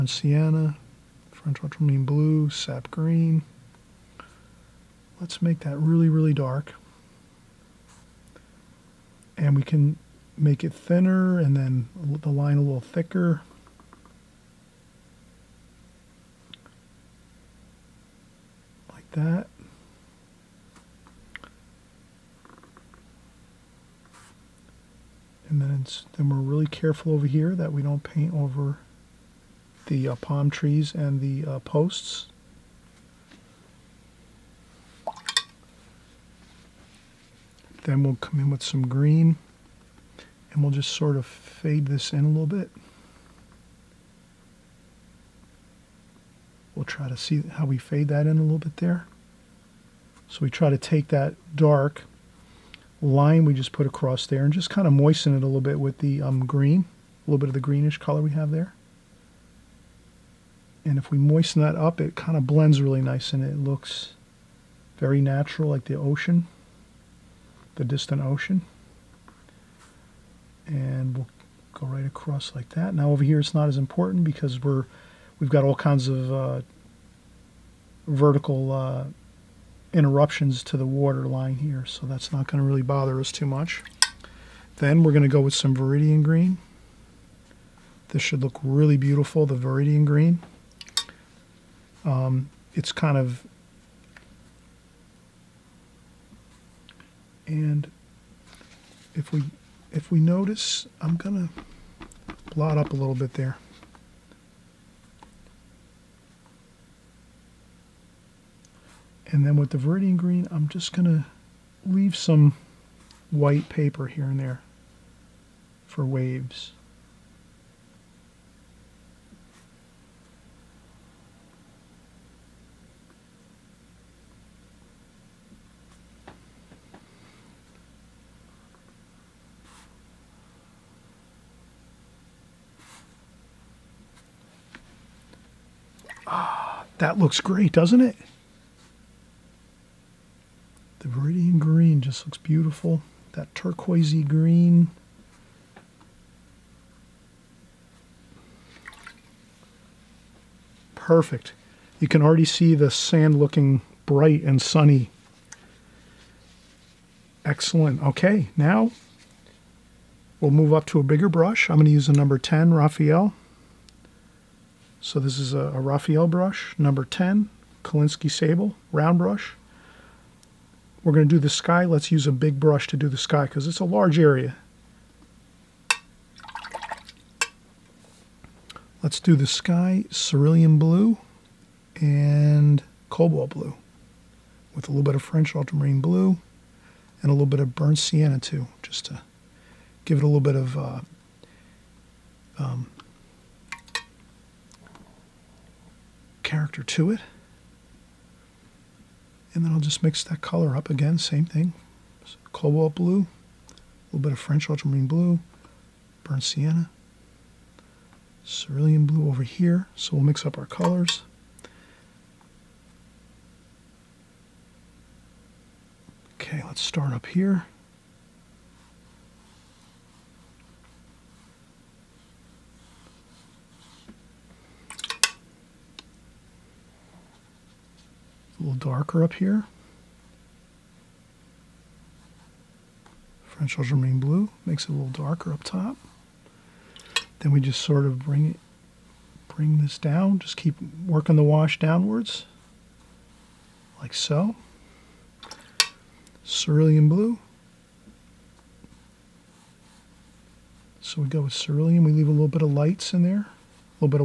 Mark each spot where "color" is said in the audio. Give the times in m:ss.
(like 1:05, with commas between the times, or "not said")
0:57, 3:20, 3:30.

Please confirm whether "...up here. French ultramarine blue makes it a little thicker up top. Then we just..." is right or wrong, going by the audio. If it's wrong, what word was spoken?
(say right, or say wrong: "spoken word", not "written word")
wrong: "darker", not "thicker".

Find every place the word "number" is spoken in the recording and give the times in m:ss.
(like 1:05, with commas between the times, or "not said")
2:42, 2:46.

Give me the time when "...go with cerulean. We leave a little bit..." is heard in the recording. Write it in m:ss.
4:11.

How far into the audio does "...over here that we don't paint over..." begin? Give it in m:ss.
0:27.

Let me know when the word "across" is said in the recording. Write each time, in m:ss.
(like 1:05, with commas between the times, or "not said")
0:53, 1:12.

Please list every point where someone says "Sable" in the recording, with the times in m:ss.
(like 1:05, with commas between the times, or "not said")
2:48.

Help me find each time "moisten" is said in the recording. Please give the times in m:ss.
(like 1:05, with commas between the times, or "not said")
0:54, 1:01.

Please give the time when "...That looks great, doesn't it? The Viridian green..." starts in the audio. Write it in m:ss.
2:16.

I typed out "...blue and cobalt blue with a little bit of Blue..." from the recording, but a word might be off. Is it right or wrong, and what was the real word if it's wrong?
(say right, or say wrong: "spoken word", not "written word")
wrong: "French", not "Blue".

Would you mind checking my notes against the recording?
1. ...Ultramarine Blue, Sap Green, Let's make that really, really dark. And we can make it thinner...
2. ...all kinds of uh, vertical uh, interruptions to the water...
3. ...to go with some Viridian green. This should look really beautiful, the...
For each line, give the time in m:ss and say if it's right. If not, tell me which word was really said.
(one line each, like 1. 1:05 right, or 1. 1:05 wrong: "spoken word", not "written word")
1. 0:01 right
2. 1:15 right
3. 1:25 right.